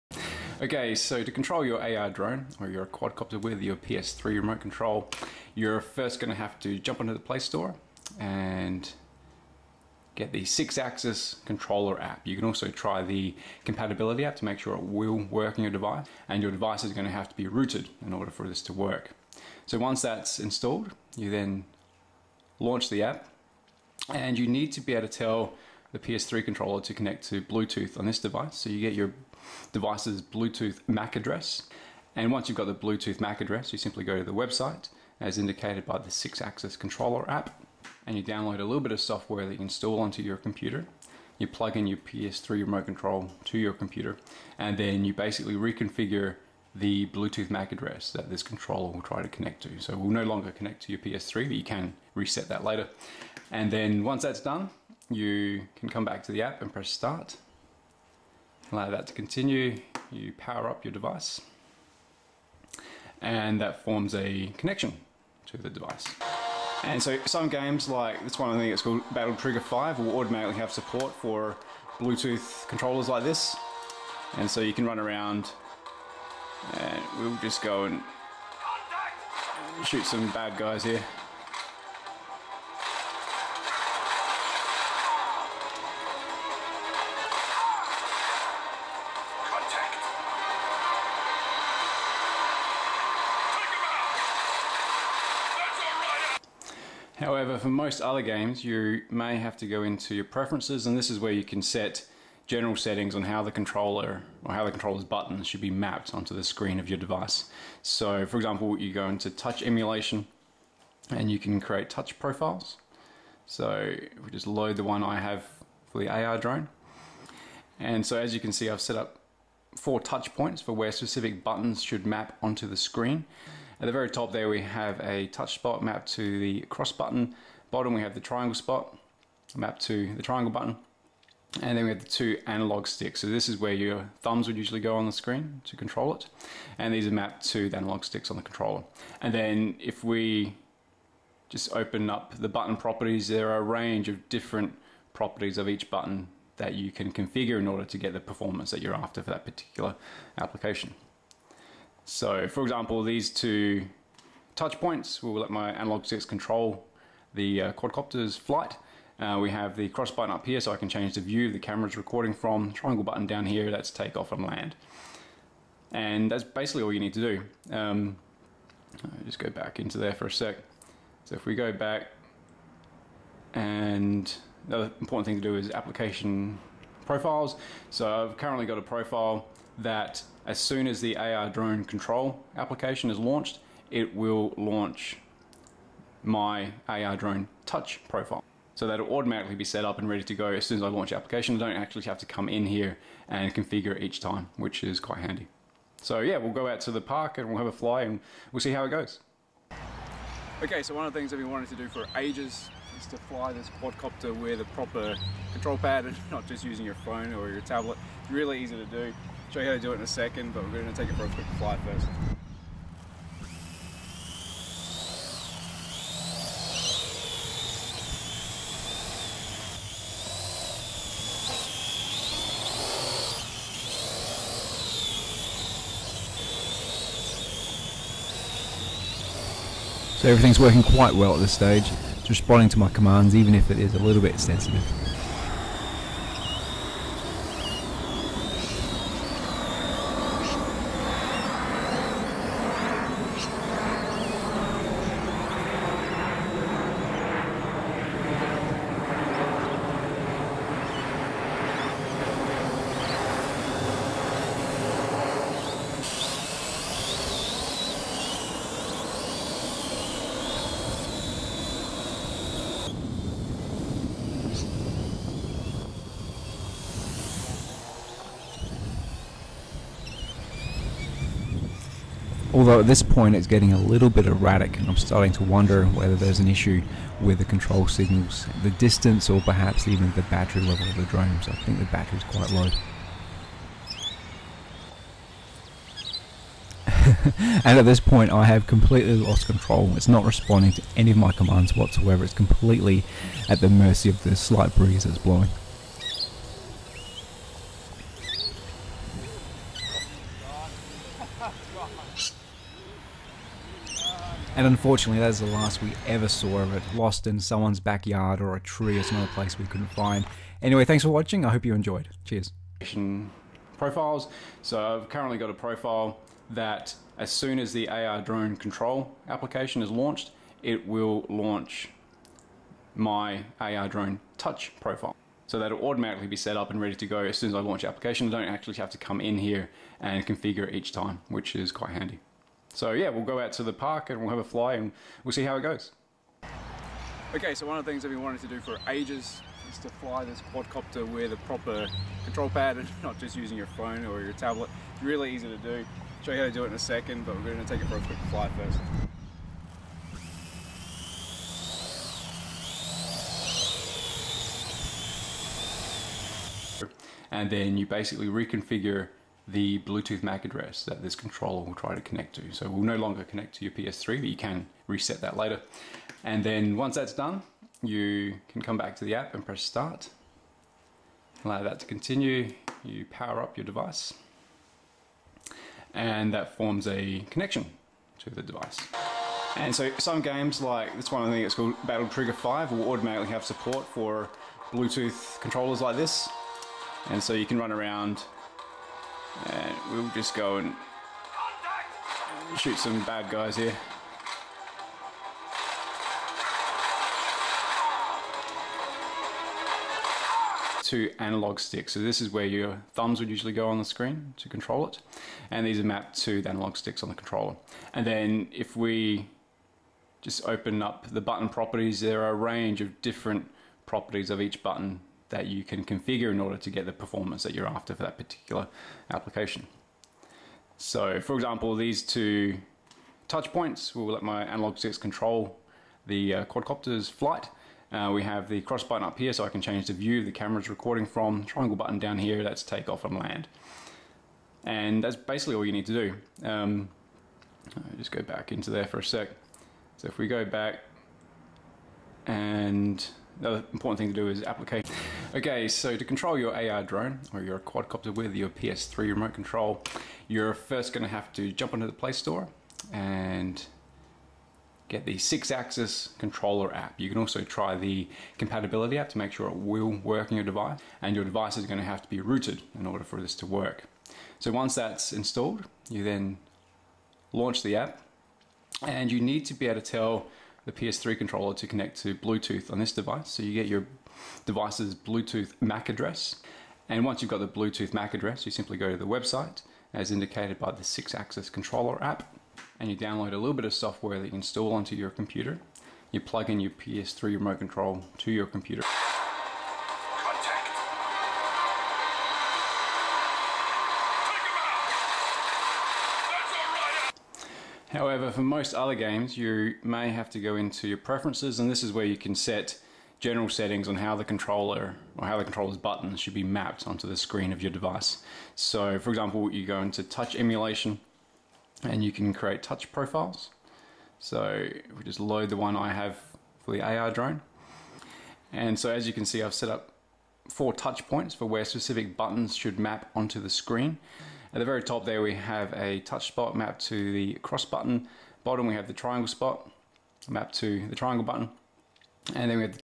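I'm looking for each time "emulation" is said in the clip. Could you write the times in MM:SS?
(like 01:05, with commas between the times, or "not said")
01:49, 08:30.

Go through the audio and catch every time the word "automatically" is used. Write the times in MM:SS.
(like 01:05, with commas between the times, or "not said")
01:10, 03:09, 05:25, 06:22.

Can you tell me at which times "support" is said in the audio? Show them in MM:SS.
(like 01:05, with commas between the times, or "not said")
01:10, 06:23.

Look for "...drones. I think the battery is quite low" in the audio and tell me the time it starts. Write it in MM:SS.
04:41.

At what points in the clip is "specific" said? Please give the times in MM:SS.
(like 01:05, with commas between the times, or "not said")
02:00, 08:41.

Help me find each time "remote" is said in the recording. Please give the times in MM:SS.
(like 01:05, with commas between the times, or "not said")
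00:04, 00:42, 07:29, 08:07.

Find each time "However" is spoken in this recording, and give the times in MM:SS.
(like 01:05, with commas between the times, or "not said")
01:37, 08:17.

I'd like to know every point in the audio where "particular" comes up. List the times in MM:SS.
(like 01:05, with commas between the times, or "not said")
02:29, 06:58.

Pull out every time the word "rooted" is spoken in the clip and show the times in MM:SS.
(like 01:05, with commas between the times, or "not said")
00:17, 07:42.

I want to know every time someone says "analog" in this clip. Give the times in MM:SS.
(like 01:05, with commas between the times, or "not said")
02:12, 02:17, 02:35, 06:41, 06:46, 07:04.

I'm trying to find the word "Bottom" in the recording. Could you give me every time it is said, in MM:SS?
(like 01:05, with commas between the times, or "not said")
02:07, 08:48.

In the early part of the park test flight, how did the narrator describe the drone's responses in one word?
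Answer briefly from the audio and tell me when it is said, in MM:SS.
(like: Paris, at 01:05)
sensitive, at 03:54.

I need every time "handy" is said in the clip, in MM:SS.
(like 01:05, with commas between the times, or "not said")
03:15, 05:31.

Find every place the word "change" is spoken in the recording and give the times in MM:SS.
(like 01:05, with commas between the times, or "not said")
02:40, 07:09.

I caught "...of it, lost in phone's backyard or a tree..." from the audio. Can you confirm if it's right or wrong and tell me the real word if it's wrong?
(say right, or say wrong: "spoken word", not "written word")
wrong: "someone", not "phone".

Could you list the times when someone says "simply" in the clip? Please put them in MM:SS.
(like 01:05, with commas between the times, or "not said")
00:33, 07:58.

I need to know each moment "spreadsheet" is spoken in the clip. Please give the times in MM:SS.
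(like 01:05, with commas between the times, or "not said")
not said.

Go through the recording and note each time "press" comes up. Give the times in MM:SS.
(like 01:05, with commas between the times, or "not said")
00:56, 06:09.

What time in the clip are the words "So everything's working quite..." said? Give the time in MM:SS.
03:50.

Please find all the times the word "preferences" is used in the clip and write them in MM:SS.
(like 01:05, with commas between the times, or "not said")
01:40, 08:20.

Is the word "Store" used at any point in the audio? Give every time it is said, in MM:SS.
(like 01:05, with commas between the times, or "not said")
00:07, 07:32.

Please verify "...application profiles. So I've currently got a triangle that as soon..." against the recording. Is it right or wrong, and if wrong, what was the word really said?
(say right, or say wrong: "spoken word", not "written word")
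wrong: "profile", not "triangle".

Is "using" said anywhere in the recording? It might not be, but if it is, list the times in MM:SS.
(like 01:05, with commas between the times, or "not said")
03:26, 05:43.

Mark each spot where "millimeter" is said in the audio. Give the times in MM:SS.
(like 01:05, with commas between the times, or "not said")
not said.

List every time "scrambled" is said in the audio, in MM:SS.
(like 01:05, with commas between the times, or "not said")
not said.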